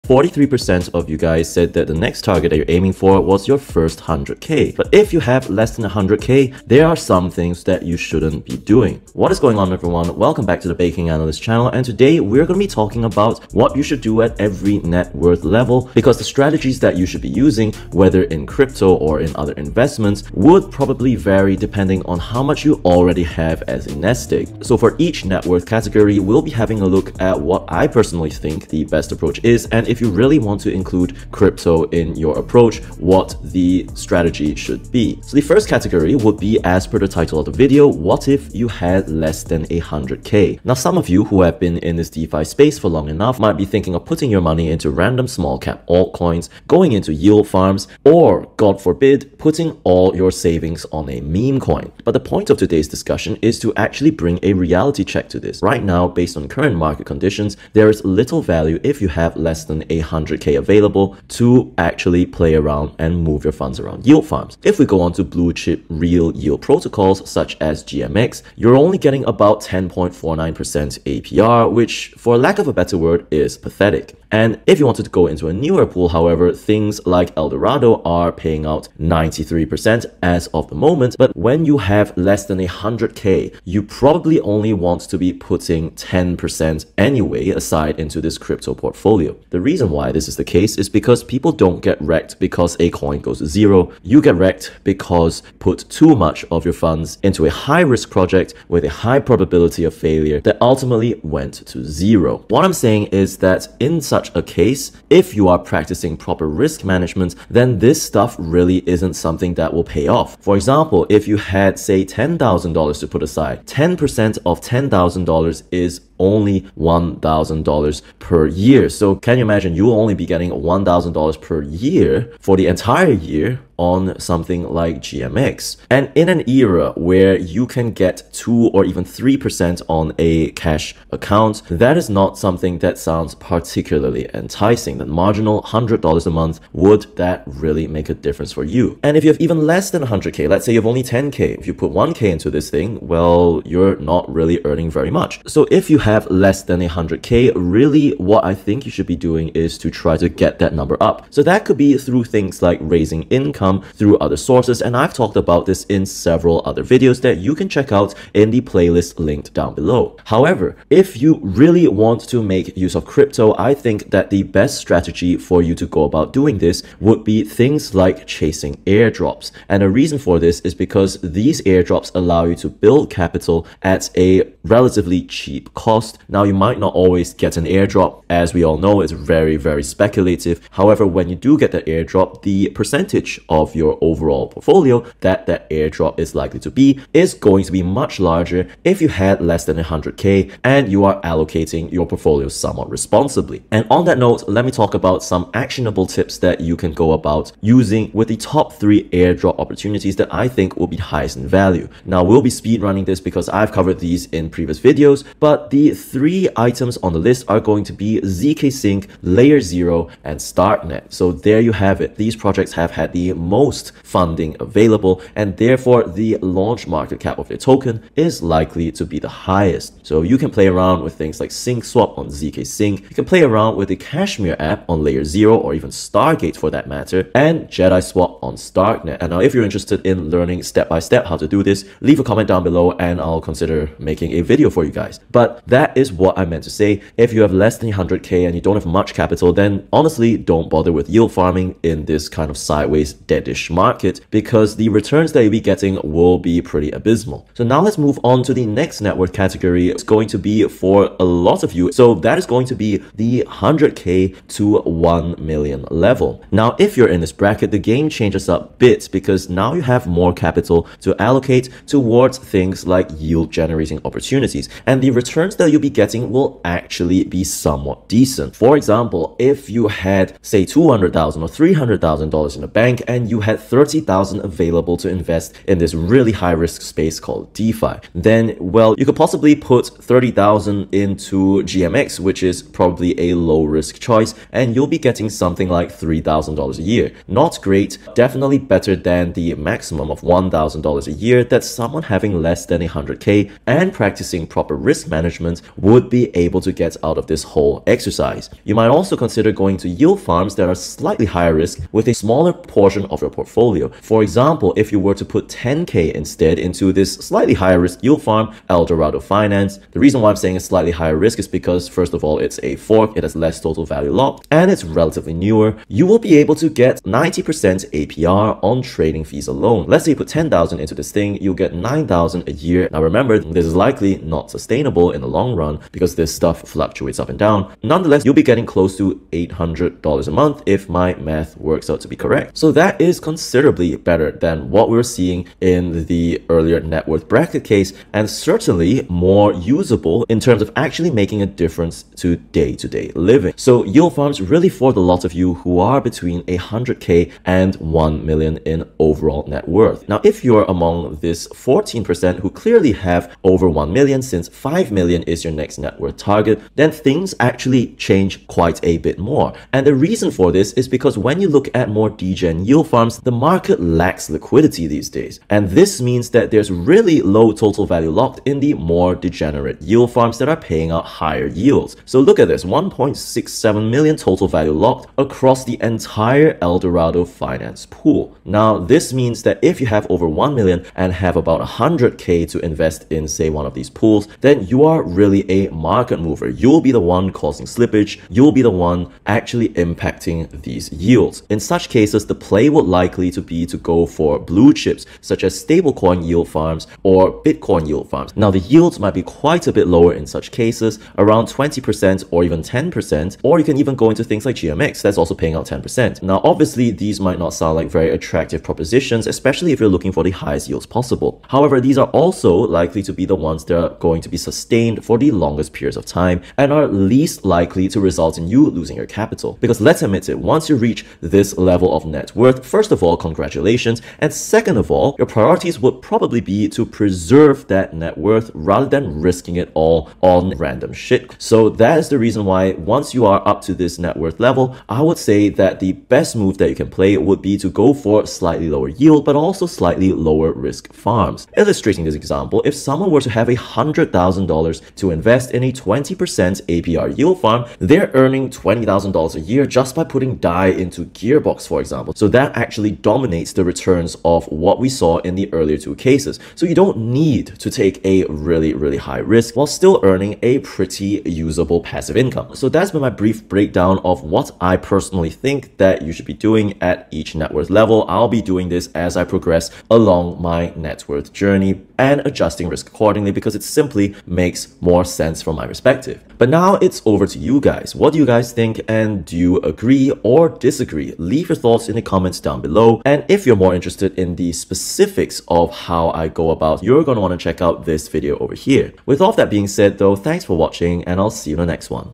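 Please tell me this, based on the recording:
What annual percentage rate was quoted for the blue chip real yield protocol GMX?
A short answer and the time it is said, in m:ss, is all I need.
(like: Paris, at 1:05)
10.49%, at 1:09.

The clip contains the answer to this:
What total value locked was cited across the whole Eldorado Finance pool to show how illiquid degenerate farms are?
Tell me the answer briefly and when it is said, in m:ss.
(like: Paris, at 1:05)
1.67 million, at 6:12.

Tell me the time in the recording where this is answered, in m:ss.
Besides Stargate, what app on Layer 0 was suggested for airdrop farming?
3:43.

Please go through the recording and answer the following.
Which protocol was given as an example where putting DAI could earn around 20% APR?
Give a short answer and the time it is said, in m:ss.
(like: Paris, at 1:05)
Gearbox, at 7:31.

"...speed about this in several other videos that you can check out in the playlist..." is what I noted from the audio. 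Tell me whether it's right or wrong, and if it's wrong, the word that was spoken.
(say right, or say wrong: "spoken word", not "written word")
wrong: "talked", not "speed".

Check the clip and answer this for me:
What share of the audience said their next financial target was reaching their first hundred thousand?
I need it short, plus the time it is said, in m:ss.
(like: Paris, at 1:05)
43%, at 0:00.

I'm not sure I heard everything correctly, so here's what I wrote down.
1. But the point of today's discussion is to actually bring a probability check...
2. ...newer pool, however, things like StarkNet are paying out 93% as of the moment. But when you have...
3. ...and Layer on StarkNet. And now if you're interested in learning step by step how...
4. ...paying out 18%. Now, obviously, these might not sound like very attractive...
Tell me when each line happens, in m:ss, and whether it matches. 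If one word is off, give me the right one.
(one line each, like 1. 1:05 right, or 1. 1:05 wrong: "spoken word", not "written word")
1. 0:52 wrong: "reality", not "probability"
2. 1:15 wrong: "Eldorado", not "StarkNet"
3. 3:47 wrong: "JediSwap", not "Layer"
4. 6:45 wrong: "10", not "18".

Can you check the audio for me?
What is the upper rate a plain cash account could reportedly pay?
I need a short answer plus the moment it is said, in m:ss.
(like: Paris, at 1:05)
3%, at 2:09.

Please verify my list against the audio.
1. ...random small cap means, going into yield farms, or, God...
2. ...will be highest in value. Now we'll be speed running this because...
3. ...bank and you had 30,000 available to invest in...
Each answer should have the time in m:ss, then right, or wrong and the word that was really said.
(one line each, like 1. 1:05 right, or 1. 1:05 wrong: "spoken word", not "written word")
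1. 0:44 wrong: "altcoins", not "means"
2. 3:20 right
3. 4:32 right.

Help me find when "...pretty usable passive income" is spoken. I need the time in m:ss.
7:40.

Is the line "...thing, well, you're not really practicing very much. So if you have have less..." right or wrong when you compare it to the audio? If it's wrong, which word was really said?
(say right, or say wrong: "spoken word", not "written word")
wrong: "earning", not "practicing".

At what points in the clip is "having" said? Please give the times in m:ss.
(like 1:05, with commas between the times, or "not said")
0:26, 4:52.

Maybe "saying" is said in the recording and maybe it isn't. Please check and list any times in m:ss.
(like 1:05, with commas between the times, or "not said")
1:42, 5:10.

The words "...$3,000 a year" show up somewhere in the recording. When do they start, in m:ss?
4:45.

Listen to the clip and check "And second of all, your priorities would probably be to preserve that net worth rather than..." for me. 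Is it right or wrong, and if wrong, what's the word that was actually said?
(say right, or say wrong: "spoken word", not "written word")
right.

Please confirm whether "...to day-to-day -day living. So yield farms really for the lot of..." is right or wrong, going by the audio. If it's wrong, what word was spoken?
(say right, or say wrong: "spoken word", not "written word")
right.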